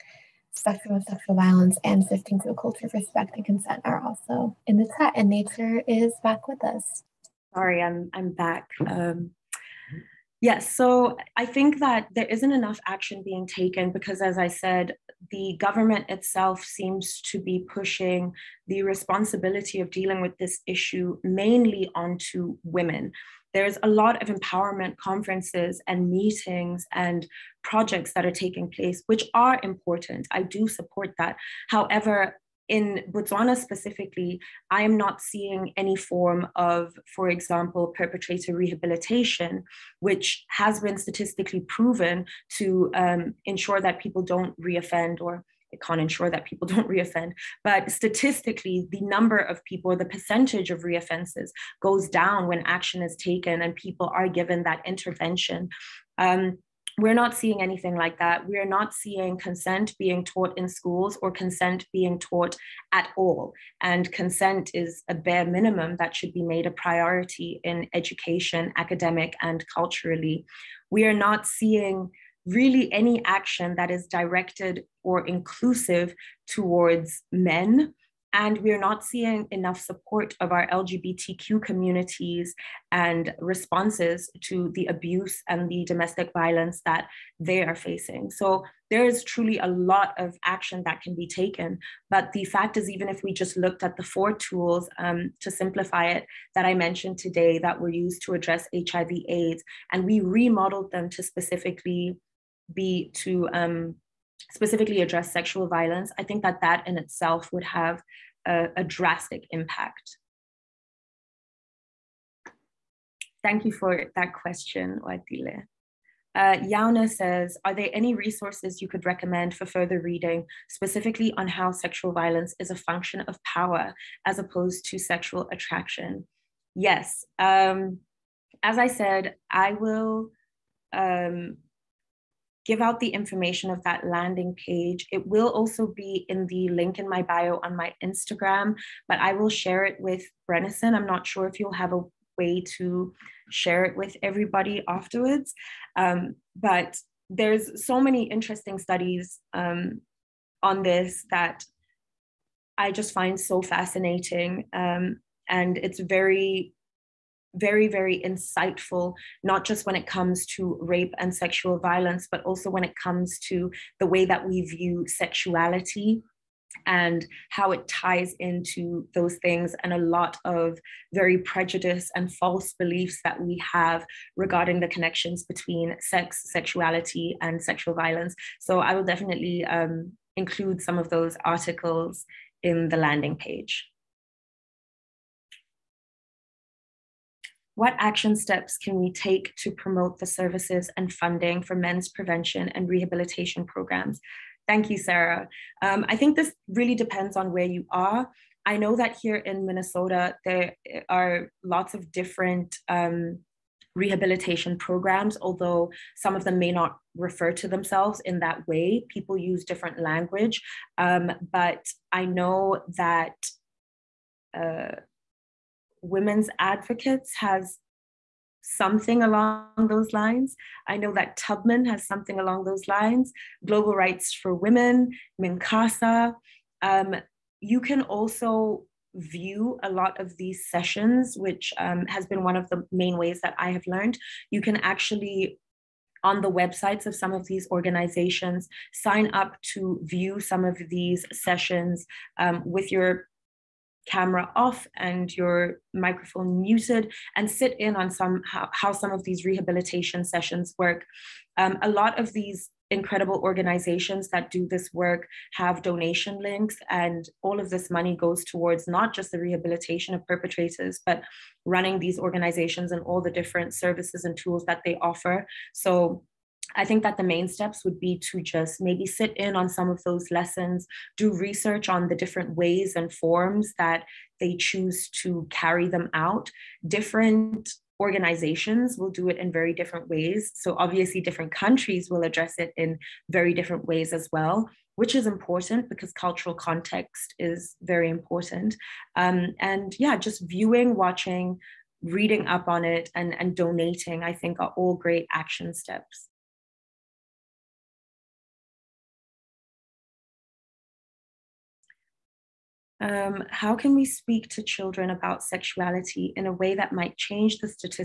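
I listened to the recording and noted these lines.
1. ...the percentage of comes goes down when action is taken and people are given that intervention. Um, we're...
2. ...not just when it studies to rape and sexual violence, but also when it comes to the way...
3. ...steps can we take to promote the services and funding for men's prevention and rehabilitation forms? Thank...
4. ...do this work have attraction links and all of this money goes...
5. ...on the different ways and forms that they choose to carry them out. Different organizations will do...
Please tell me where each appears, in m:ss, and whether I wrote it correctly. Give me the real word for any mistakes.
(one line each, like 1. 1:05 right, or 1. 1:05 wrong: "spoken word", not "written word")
1. 0:49 wrong: "reoffenses", not "comes"
2. 2:39 wrong: "comes", not "studies"
3. 3:08 wrong: "programs", not "forms"
4. 4:14 wrong: "donation", not "attraction"
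5. 4:31 right.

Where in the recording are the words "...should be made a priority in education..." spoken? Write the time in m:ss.
1:06.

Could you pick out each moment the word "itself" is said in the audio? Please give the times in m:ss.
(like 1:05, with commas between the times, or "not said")
0:16, 1:46.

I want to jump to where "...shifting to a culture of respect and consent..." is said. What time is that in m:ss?
0:02.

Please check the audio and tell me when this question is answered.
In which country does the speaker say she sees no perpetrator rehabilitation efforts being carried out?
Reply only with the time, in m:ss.
0:33.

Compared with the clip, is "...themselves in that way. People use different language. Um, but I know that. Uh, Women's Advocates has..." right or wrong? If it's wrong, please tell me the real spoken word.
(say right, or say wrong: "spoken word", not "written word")
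right.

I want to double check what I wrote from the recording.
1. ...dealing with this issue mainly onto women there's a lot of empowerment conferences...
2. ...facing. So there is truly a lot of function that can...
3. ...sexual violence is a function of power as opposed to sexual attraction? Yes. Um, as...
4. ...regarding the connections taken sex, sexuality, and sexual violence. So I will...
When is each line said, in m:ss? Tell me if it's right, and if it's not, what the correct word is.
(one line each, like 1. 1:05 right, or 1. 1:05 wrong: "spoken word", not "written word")
1. 0:19 right
2. 1:27 wrong: "action", not "function"
3. 2:01 right
4. 2:54 wrong: "between", not "taken".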